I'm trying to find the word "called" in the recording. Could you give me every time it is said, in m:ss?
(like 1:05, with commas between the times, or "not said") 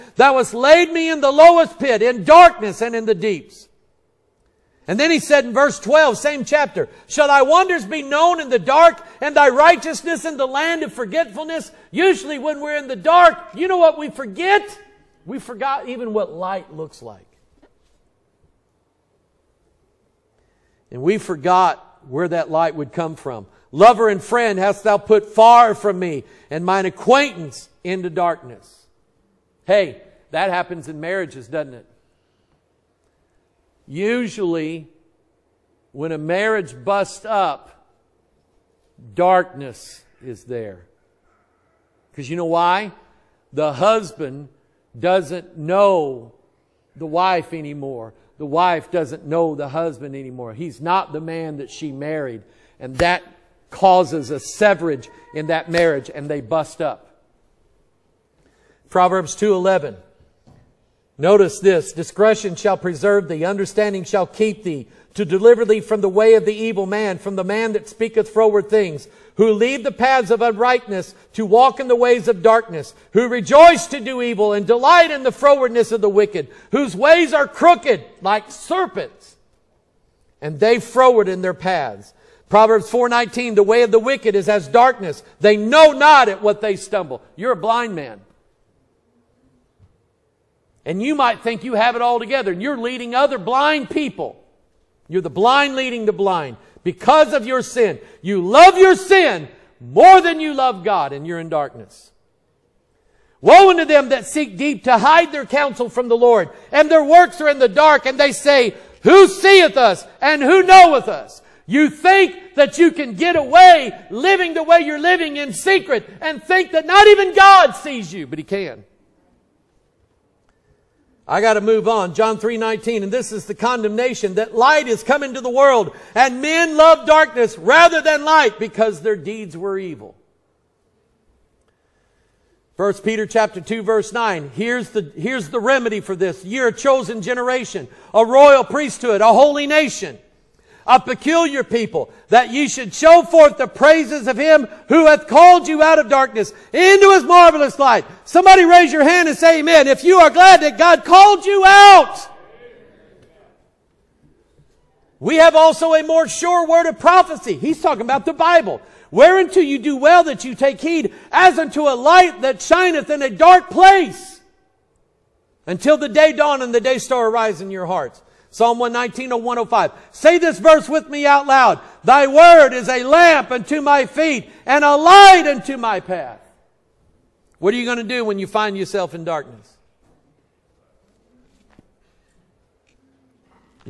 2:25, 2:31.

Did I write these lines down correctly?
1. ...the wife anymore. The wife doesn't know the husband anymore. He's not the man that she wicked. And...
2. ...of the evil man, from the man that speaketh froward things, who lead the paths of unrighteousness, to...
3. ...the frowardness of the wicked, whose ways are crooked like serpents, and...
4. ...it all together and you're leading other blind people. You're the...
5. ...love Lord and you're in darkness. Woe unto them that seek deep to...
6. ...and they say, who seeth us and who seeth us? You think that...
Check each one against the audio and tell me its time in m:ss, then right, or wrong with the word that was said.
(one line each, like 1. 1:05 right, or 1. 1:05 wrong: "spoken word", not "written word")
1. 0:46 wrong: "married", not "wicked"
2. 1:06 right
3. 1:15 right
4. 1:31 right
5. 1:40 wrong: "God", not "Lord"
6. 1:48 wrong: "knoweth", not "seeth".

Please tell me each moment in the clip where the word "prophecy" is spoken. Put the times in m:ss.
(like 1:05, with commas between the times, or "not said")
2:36.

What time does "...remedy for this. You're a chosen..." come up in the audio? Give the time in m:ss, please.
2:15.